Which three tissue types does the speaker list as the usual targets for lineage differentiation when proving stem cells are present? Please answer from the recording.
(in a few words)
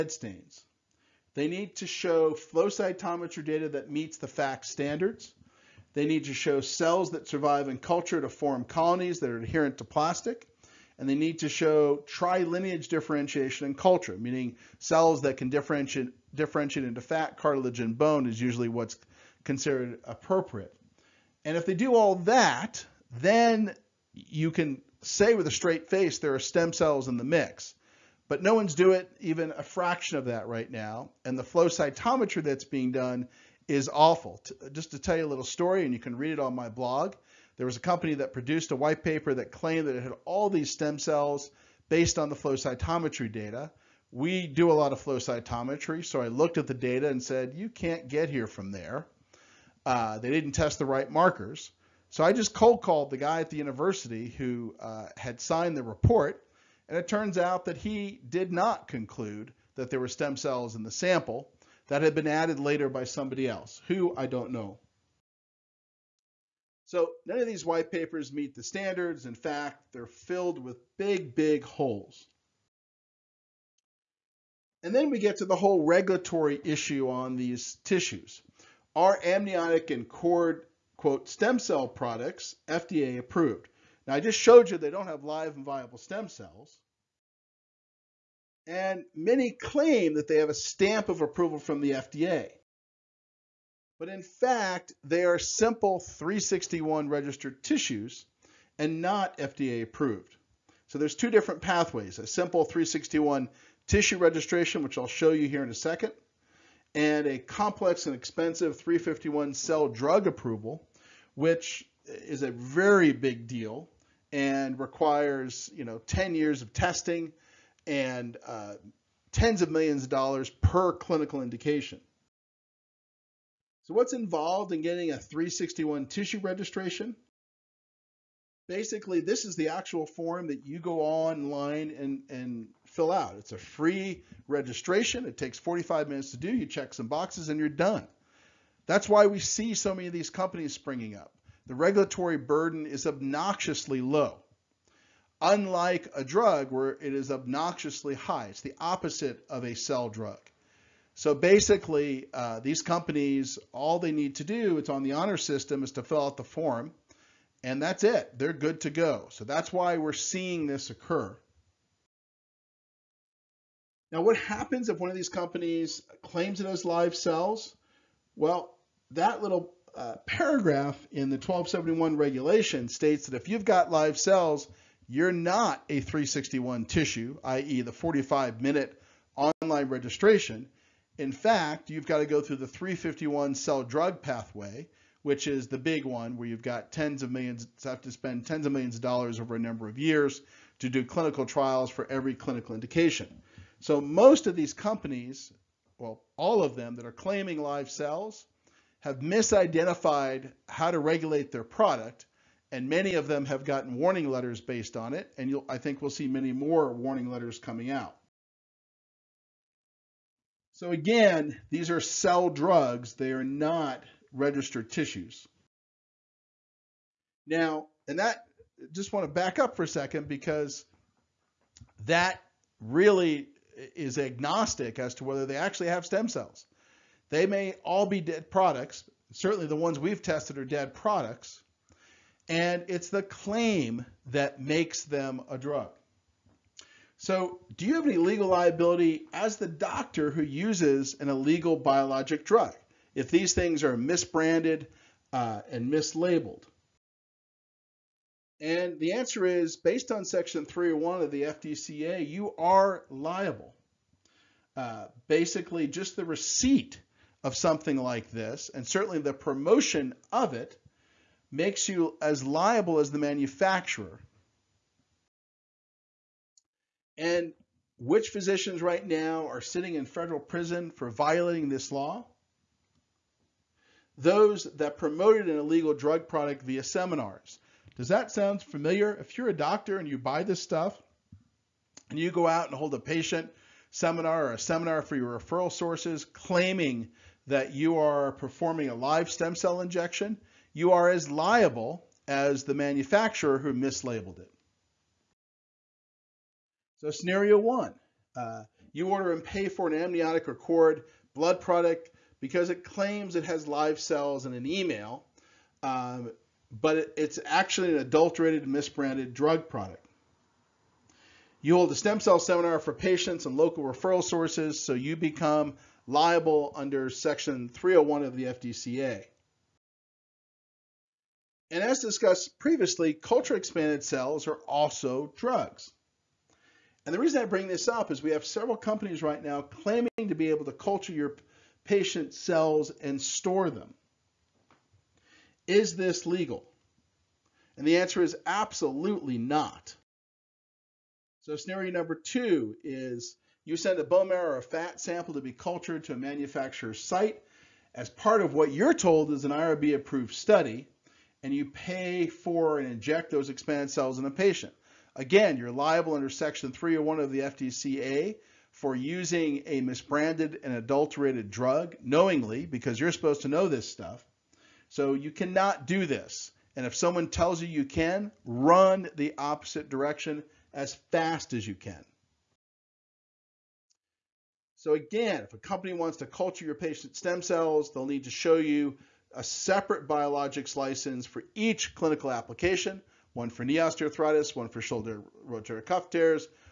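fat, cartilage, and bone.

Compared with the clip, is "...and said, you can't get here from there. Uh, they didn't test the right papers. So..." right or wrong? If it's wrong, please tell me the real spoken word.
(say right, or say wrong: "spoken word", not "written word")
wrong: "markers", not "papers".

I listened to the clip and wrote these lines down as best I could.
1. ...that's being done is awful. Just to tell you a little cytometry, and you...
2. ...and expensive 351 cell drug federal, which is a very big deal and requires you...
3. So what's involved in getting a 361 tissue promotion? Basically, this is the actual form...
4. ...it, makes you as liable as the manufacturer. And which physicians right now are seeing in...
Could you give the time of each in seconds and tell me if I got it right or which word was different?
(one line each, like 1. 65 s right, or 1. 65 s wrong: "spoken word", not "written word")
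1. 32 s wrong: "story", not "cytometry"
2. 108 s wrong: "approval", not "federal"
3. 123 s wrong: "registration", not "promotion"
4. 260 s wrong: "sitting", not "seeing".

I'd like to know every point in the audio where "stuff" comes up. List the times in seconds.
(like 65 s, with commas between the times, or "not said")
280 s, 363 s.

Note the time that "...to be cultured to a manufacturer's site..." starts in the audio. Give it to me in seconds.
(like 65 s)
345 s.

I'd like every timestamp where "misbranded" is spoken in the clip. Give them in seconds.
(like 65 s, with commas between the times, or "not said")
243 s, 308 s, 359 s.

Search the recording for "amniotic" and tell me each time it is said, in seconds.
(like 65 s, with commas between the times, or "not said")
79 s, 299 s.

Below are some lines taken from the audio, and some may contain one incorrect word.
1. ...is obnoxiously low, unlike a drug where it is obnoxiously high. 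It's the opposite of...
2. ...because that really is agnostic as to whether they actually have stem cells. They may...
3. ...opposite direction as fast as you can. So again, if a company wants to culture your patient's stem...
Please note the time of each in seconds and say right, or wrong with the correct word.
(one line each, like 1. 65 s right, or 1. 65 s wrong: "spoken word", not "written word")
1. 142 s right
2. 220 s right
3. 369 s right.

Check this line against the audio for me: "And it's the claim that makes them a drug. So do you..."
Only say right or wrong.
right.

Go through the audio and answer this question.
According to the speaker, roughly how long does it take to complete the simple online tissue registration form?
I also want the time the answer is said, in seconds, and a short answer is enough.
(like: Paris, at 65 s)
45 minutes, at 135 s.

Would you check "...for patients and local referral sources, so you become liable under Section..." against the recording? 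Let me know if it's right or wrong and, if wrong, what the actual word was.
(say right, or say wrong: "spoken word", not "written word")
right.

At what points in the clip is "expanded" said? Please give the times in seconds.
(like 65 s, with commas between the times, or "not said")
323 s, 353 s.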